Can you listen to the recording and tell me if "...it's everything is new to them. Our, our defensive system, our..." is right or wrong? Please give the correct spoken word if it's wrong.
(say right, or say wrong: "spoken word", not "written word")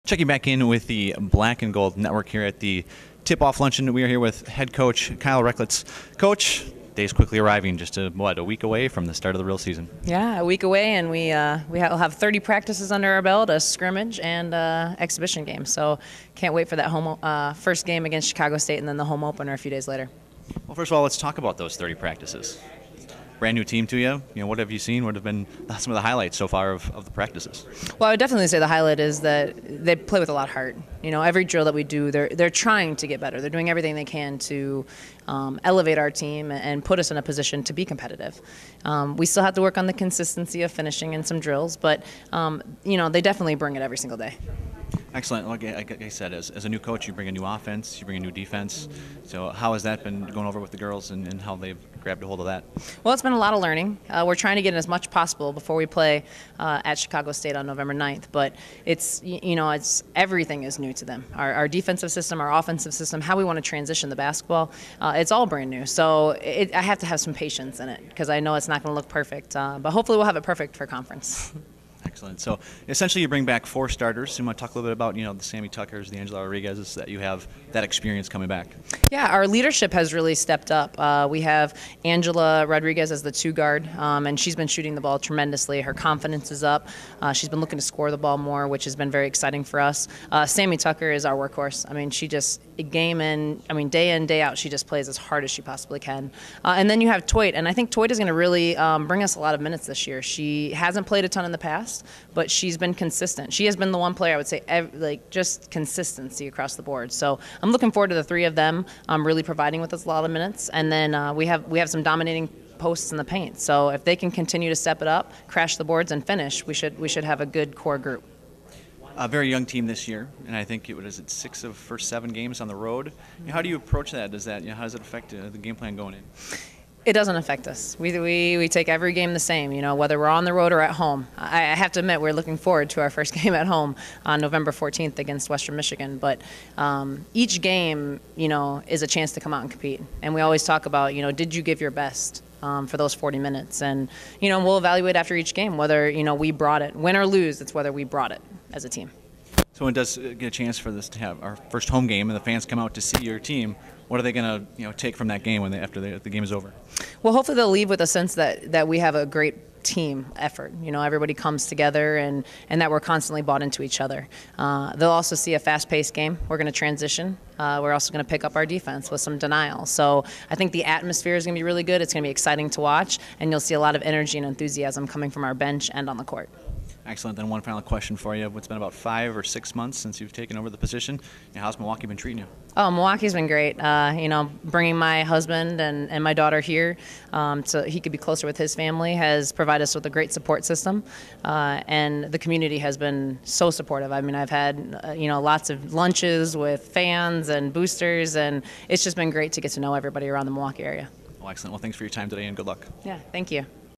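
right.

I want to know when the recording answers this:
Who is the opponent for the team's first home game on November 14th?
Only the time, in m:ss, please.
2:15.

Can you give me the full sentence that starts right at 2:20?
And we always talk about, you know, did you give your best?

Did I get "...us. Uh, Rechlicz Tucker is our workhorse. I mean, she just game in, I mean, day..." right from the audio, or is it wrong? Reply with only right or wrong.
wrong.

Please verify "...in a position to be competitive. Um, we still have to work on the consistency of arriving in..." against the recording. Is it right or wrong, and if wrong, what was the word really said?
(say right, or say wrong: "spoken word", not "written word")
wrong: "finishing", not "arriving".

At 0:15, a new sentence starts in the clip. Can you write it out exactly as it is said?
So can't wait for that home uh, first game against Chicago State, and then the home opener a few days later.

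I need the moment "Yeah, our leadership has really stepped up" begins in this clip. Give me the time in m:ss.
1:19.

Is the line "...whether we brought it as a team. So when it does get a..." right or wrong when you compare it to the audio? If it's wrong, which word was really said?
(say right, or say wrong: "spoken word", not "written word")
right.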